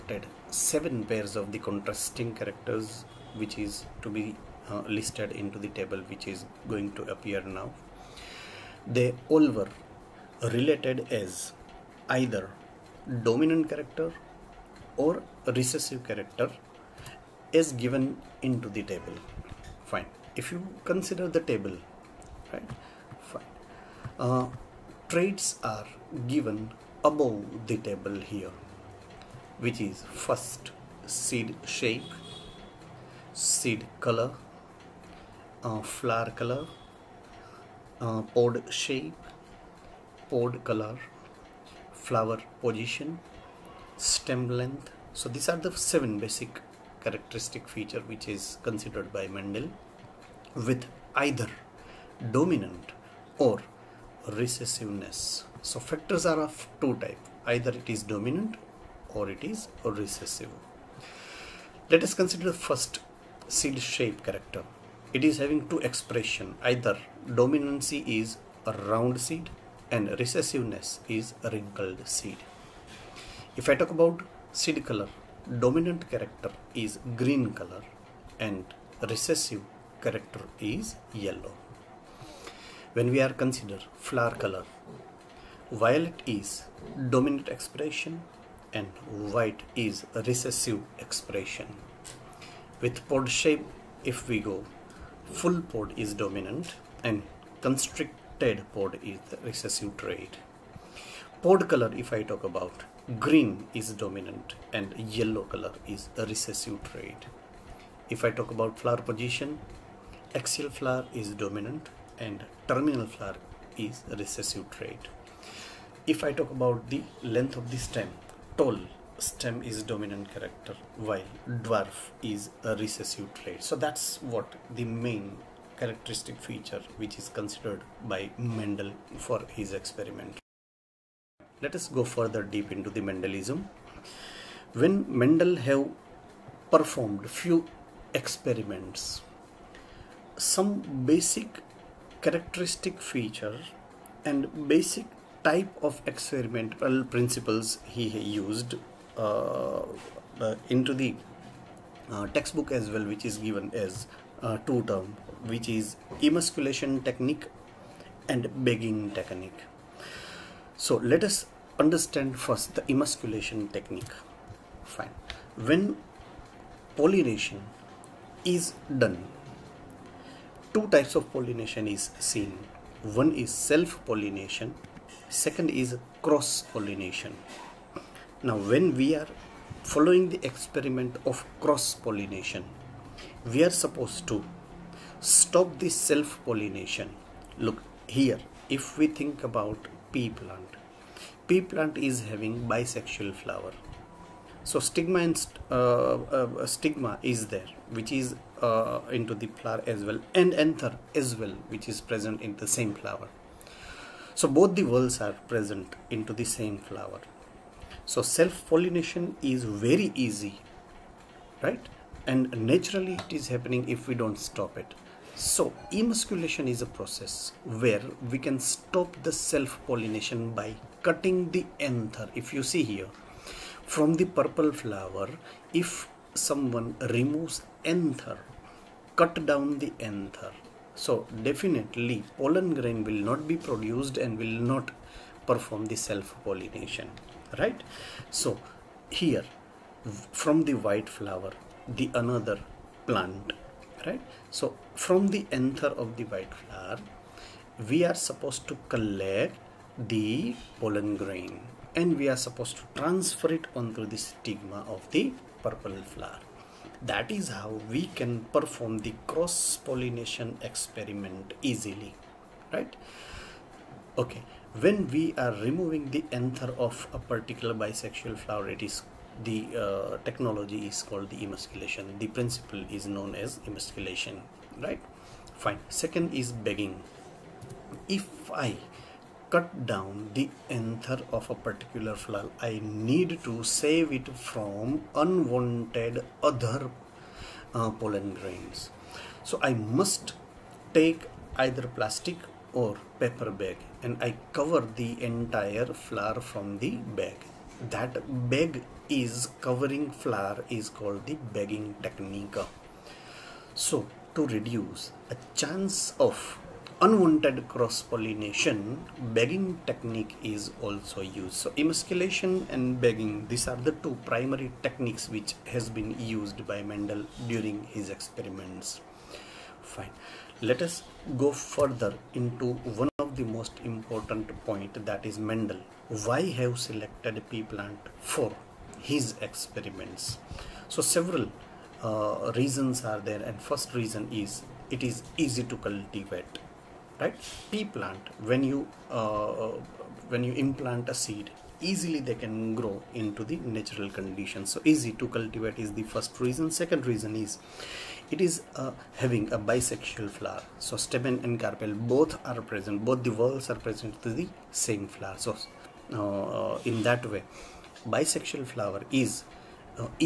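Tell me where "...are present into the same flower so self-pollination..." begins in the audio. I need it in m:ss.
3:25.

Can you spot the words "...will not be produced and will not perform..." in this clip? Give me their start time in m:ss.
3:53.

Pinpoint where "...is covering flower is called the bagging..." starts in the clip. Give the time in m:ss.
4:59.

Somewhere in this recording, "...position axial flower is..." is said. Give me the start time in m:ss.
1:49.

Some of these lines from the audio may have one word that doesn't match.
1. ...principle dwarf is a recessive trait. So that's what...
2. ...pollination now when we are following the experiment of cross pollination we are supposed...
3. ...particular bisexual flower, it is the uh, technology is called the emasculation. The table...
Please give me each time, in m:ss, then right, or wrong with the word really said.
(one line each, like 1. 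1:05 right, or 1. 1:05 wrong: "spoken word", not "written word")
1. 2:00 wrong: "while", not "principle"
2. 2:56 right
3. 4:27 wrong: "principle", not "table".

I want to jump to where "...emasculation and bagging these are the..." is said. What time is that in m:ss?
5:11.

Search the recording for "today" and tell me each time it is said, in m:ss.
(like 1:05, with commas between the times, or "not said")
not said.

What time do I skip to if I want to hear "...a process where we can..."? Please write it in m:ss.
3:36.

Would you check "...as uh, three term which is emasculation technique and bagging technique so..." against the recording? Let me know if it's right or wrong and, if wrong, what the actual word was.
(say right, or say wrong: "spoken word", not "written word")
wrong: "two", not "three".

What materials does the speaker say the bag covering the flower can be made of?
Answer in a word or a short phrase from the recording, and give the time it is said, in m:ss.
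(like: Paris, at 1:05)
Plastic or paper, at 4:51.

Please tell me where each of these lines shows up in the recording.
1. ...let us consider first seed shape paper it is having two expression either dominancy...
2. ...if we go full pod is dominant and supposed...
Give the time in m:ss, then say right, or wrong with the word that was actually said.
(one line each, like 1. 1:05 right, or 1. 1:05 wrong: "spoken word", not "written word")
1. 1:01 wrong: "character", not "paper"
2. 1:34 wrong: "constricted", not "supposed".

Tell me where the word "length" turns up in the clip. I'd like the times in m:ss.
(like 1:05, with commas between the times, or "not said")
0:44, 1:57.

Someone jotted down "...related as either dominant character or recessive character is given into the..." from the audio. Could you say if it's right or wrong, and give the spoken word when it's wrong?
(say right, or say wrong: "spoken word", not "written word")
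right.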